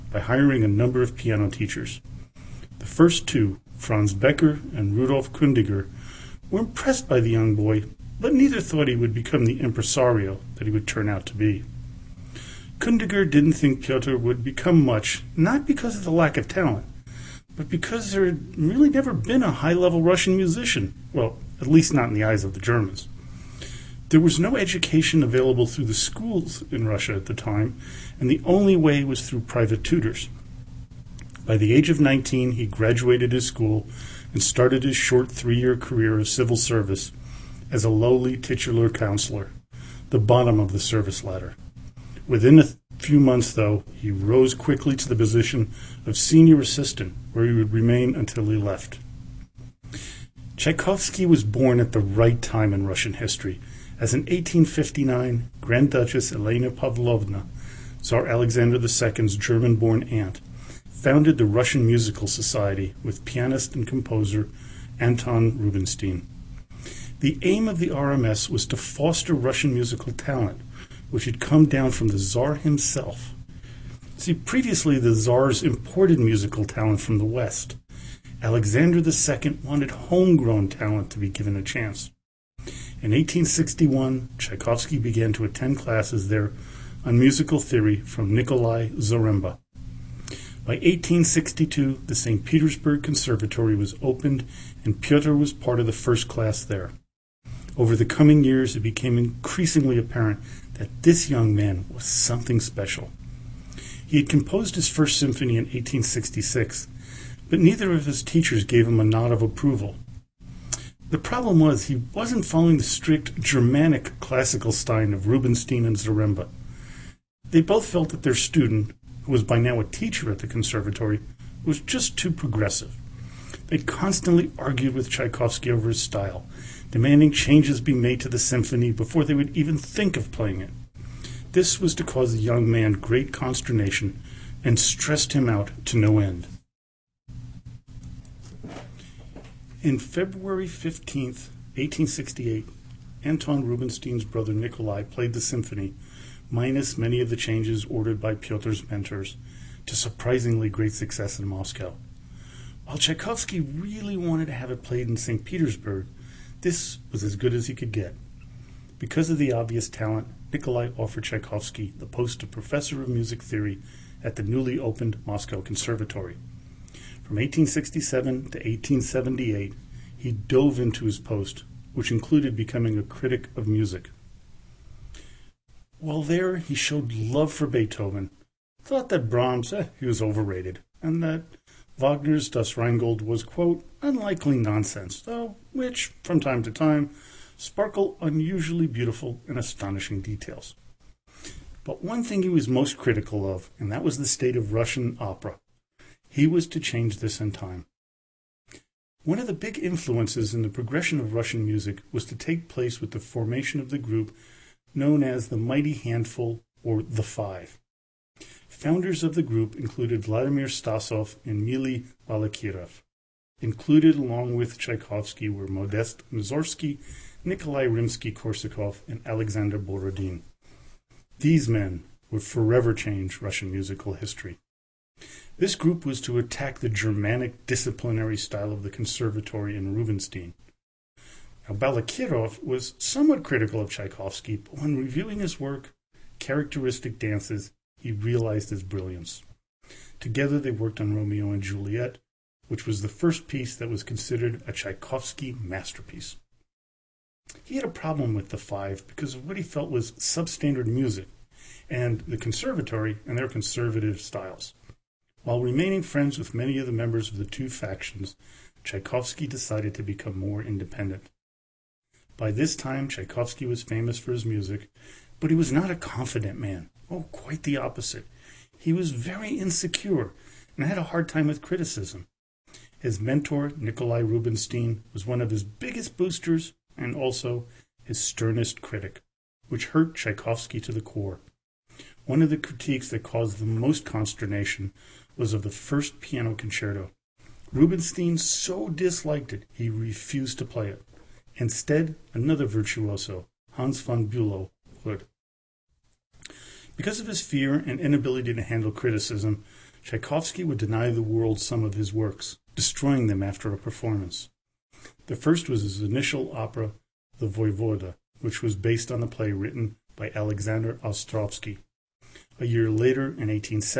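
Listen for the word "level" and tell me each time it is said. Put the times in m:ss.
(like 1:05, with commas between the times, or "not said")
0:19.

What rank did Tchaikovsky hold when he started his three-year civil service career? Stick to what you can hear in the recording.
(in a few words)
titular counselor.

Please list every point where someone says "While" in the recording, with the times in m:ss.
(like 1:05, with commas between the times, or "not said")
2:32, 2:55, 4:15.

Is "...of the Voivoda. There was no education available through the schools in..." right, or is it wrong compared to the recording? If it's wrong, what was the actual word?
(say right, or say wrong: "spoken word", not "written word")
wrong: "Germans", not "Voivoda".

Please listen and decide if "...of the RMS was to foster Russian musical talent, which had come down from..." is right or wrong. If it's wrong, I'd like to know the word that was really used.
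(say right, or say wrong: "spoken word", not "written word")
right.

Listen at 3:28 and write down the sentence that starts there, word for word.
Founders of the group included Vladimir Stasov and Mili Balakirev.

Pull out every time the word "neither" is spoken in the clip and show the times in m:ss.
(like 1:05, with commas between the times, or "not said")
0:08, 1:47.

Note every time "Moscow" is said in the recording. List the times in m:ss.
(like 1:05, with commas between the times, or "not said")
2:31, 2:45.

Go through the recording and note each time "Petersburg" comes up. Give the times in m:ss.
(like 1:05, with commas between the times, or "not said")
1:32, 2:35.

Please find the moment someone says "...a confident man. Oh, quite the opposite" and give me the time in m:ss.
4:25.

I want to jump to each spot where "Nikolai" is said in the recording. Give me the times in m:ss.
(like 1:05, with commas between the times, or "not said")
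1:28, 2:24, 2:40, 3:37, 4:33.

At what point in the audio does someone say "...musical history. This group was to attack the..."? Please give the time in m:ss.
3:43.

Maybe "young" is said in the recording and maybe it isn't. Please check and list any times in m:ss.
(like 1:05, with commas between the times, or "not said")
0:07, 1:41, 2:12.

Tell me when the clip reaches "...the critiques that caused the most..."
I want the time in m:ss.
4:42.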